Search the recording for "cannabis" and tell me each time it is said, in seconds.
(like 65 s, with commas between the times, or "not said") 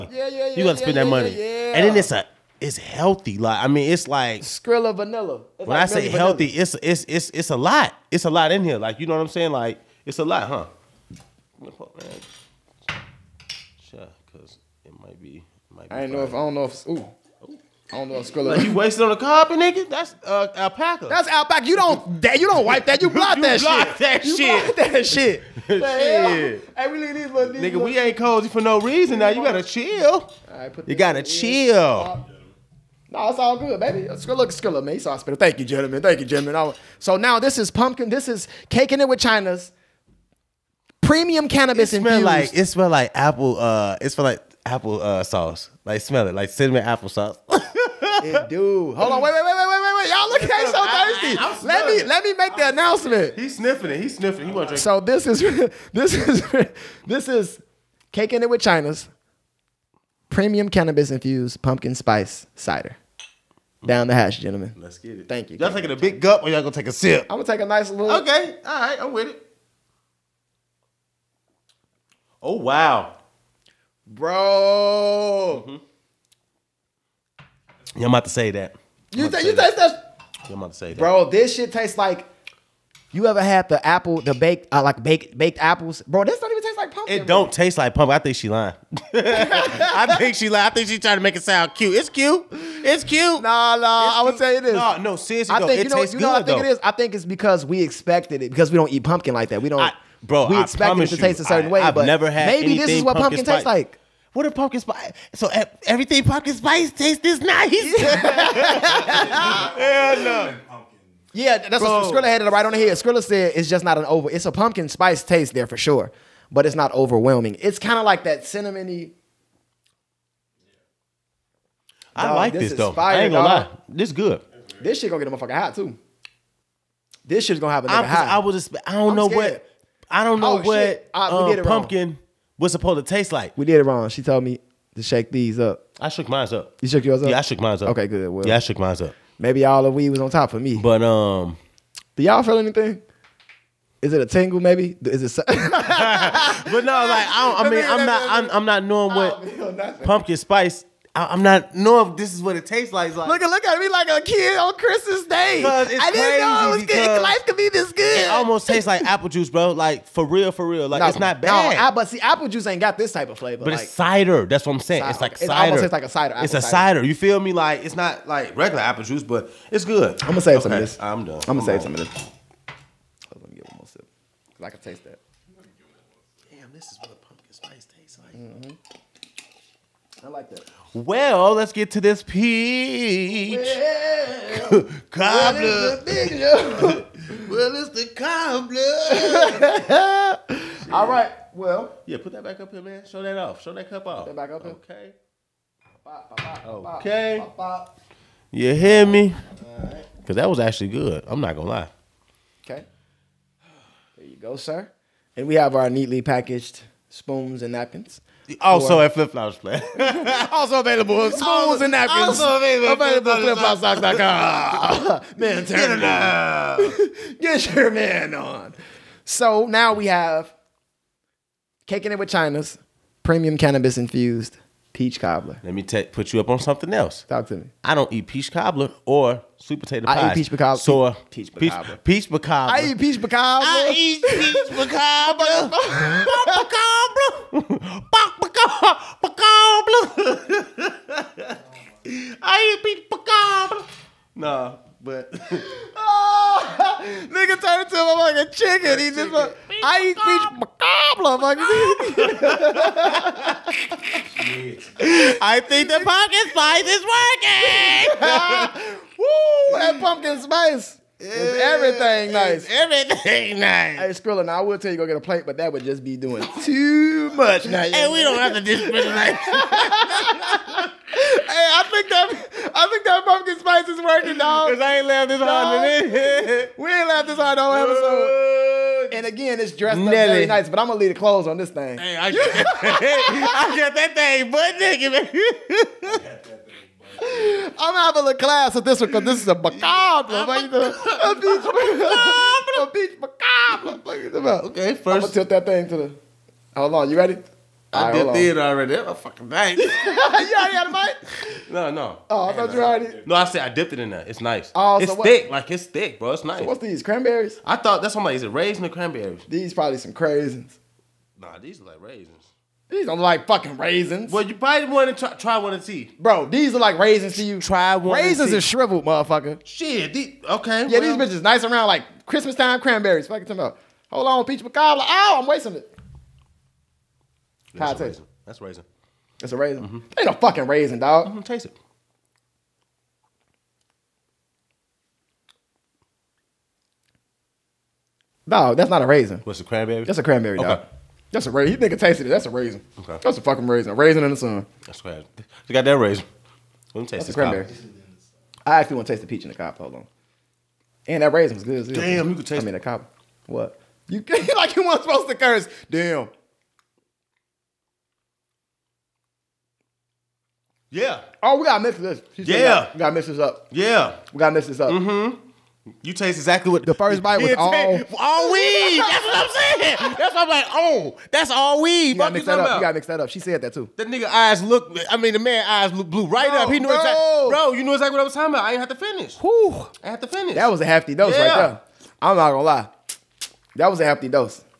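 41 s, 60 s, 223 s.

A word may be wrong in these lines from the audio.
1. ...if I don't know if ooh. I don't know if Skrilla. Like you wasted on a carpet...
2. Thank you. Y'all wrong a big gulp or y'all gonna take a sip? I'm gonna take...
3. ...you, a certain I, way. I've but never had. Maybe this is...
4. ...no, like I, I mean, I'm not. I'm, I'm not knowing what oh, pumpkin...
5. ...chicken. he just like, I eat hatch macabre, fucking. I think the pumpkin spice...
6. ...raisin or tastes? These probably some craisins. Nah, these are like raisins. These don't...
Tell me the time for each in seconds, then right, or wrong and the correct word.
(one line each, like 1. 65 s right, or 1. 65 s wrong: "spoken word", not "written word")
1. 16 s right
2. 65 s wrong: "taking", not "wrong"
3. 101 s right
4. 145 s right
5. 248 s wrong: "peach", not "hatch"
6. 308 s wrong: "cranberries", not "tastes".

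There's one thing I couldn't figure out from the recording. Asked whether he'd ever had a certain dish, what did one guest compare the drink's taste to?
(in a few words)
baked apples.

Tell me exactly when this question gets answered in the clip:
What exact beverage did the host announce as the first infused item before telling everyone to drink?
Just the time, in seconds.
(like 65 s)
61 s.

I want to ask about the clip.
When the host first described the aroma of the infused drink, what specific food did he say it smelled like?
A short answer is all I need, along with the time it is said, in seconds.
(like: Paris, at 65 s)
cinnamon apple sauce, at 46 s.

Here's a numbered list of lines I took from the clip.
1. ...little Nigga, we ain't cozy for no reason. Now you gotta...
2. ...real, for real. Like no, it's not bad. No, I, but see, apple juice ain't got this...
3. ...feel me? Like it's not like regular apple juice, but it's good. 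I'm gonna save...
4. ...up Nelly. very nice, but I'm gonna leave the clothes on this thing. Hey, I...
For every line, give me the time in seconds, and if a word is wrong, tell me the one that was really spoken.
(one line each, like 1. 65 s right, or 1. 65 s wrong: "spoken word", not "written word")
1. 27 s right
2. 160 s right
3. 167 s right
4. 279 s right.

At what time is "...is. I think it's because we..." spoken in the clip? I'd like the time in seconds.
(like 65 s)
96 s.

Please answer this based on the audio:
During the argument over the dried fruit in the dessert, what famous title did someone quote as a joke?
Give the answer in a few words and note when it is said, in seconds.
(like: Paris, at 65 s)
A Raisin in the Sun, at 343 s.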